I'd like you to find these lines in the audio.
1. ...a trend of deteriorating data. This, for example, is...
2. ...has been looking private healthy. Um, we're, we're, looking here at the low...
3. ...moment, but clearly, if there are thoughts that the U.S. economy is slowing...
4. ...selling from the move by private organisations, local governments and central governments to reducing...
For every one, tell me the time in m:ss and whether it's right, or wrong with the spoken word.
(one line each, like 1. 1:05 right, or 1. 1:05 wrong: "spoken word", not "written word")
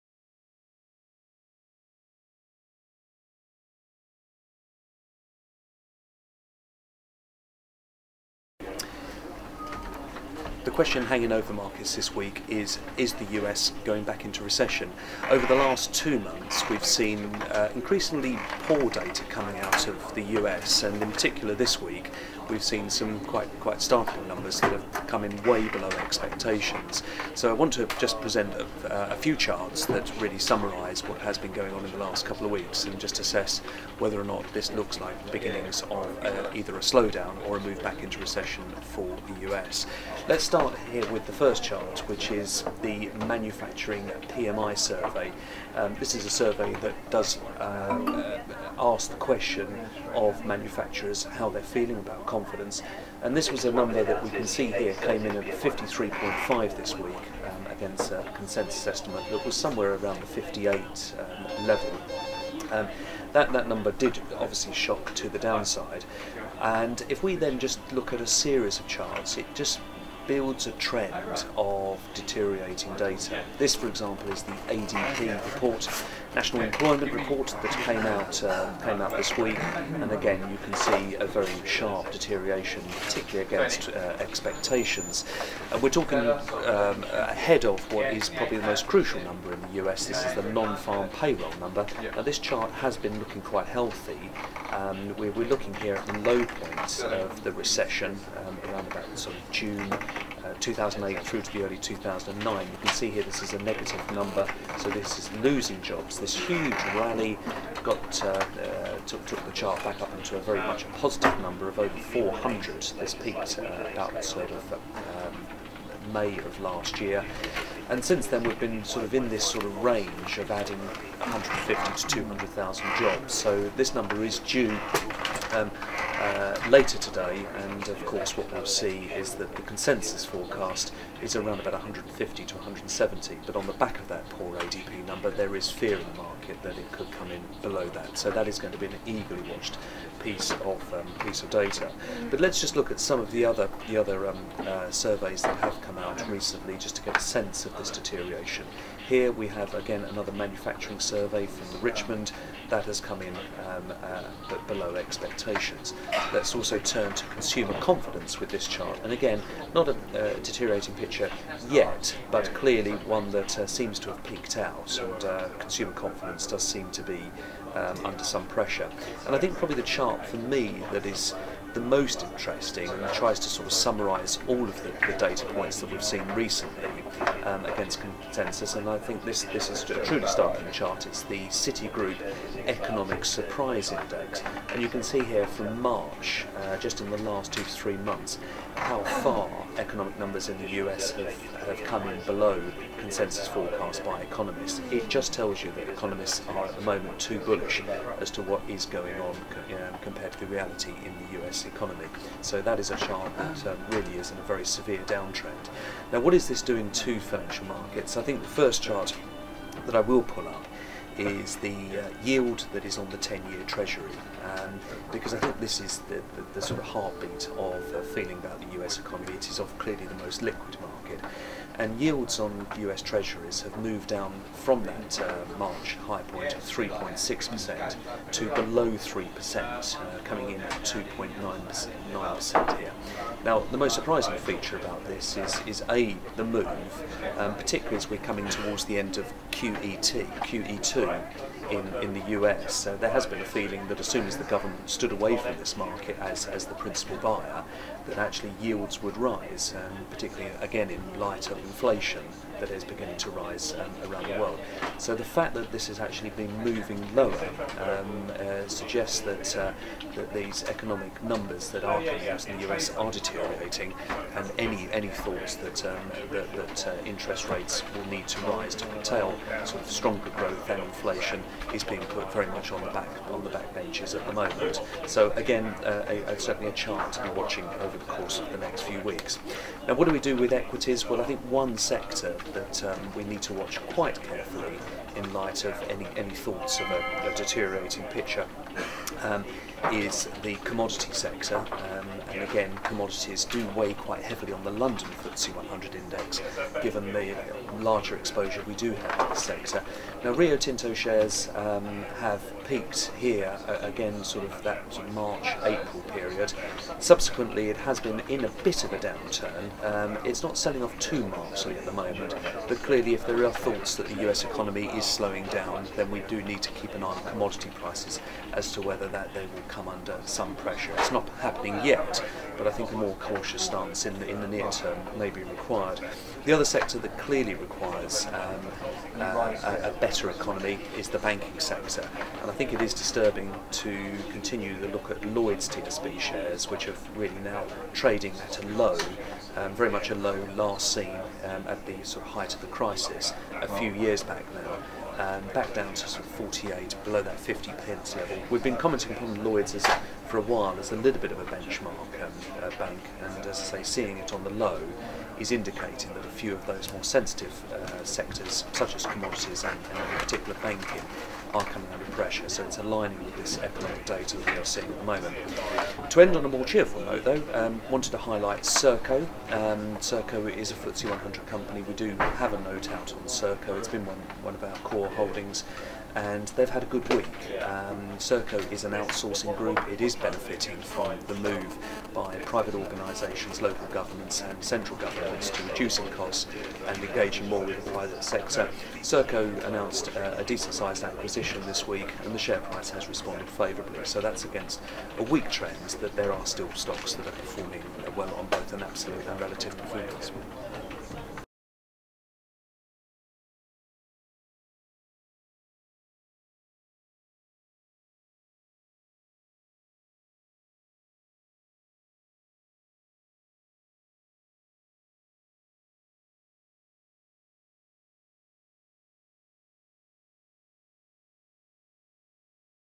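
1. 1:10 right
2. 1:32 wrong: "quite", not "private"
3. 5:11 right
4. 6:20 wrong: "benefiting", not "selling".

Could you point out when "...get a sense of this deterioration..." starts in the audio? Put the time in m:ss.
2:27.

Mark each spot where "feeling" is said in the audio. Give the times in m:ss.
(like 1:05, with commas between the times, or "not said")
0:51, 3:38, 4:03.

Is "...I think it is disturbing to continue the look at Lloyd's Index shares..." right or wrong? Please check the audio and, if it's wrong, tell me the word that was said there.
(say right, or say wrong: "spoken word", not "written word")
wrong: "TSB", not "Index".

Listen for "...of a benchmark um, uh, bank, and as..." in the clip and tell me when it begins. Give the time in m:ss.
5:51.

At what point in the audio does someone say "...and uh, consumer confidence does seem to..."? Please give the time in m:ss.
2:45.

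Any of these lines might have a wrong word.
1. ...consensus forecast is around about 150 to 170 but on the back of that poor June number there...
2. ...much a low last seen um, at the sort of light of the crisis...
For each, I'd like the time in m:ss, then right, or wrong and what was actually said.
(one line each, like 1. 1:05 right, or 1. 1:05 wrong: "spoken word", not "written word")
1. 2:09 wrong: "ADP", not "June"
2. 5:39 wrong: "height", not "light".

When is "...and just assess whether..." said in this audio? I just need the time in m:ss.
0:32.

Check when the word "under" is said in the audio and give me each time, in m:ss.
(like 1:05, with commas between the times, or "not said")
2:48, 5:19, 6:01.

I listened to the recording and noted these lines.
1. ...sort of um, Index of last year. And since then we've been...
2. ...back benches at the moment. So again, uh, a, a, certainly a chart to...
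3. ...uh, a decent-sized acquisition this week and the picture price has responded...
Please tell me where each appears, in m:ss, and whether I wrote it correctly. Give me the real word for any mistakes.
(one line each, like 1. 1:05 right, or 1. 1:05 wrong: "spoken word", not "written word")
1. 1:54 wrong: "May", not "Index"
2. 4:33 right
3. 6:30 wrong: "share", not "picture".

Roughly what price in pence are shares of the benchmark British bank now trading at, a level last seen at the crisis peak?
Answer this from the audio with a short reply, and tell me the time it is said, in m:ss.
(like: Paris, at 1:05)
48, at 5:46.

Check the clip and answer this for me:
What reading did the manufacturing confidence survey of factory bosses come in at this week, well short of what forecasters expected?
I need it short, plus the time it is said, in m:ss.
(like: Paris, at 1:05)
53.5, at 0:55.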